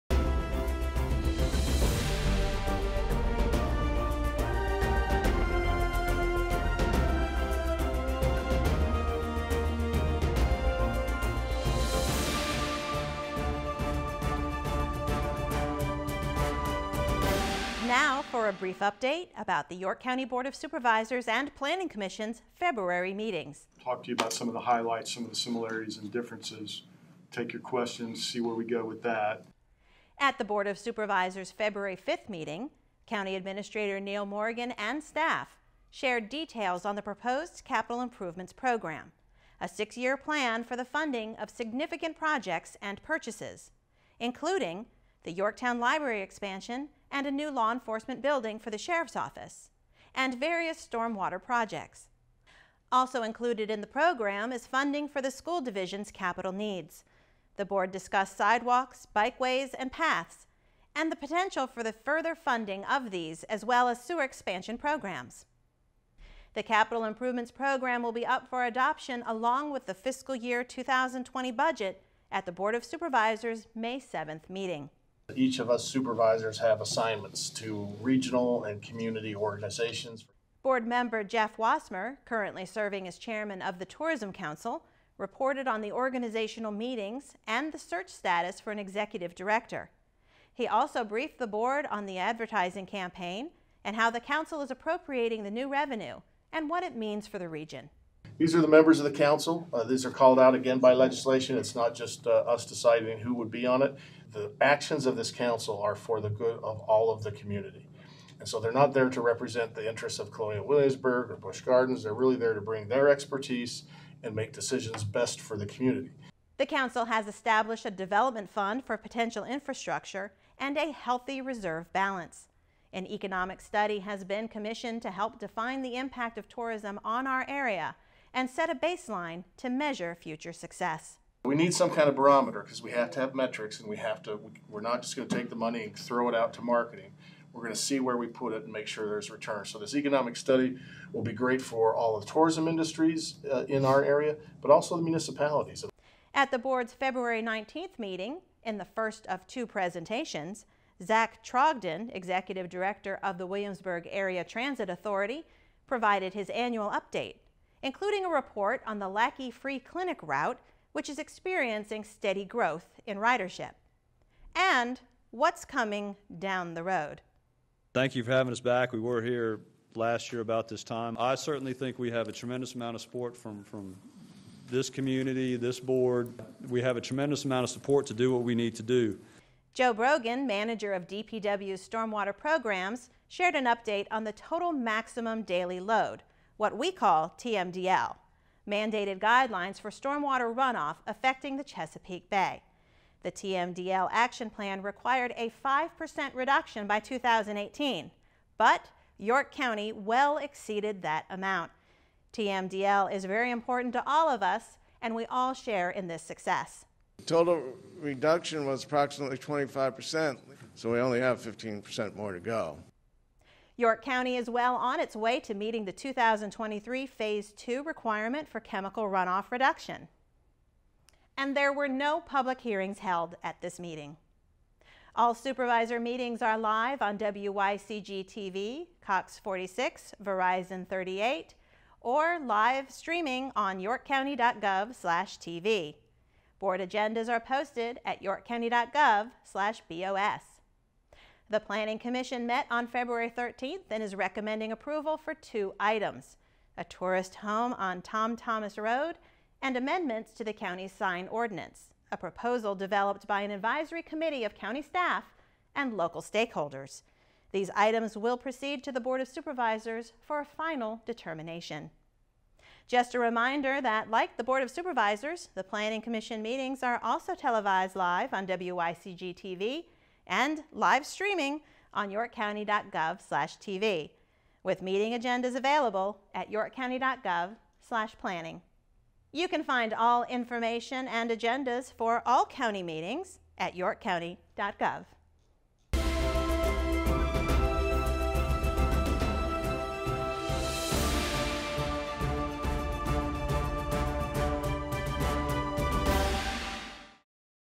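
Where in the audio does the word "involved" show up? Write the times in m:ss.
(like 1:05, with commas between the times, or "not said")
not said.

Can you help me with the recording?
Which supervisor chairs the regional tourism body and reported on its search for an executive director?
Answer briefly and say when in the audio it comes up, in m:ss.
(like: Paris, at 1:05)
Jeff Wassmer, at 1:21.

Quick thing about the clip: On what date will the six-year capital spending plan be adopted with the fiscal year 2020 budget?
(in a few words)
May 7th.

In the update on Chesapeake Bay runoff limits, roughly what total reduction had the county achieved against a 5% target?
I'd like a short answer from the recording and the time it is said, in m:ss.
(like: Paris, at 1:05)
25%, at 3:28.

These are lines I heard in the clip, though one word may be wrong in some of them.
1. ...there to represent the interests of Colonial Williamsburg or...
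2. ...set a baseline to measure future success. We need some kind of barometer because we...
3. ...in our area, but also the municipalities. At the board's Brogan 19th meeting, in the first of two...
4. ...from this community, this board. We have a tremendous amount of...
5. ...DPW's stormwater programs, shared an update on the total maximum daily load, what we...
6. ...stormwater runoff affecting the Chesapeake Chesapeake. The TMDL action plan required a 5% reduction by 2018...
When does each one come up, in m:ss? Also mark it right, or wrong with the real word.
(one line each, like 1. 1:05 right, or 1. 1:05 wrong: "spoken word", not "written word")
1. 1:48 right
2. 2:08 right
3. 2:23 wrong: "February", not "Brogan"
4. 2:53 right
5. 3:01 right
6. 3:09 wrong: "Bay", not "Chesapeake".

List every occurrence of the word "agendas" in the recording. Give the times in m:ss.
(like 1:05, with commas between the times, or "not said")
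3:56, 4:35, 4:41.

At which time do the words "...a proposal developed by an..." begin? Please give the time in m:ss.
4:12.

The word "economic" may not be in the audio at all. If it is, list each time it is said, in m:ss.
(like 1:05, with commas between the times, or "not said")
2:03, 2:19.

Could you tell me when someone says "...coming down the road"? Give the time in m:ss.
2:45.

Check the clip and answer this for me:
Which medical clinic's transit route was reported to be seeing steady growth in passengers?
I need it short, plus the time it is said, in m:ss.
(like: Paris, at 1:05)
Lackey Free Clinic, at 2:39.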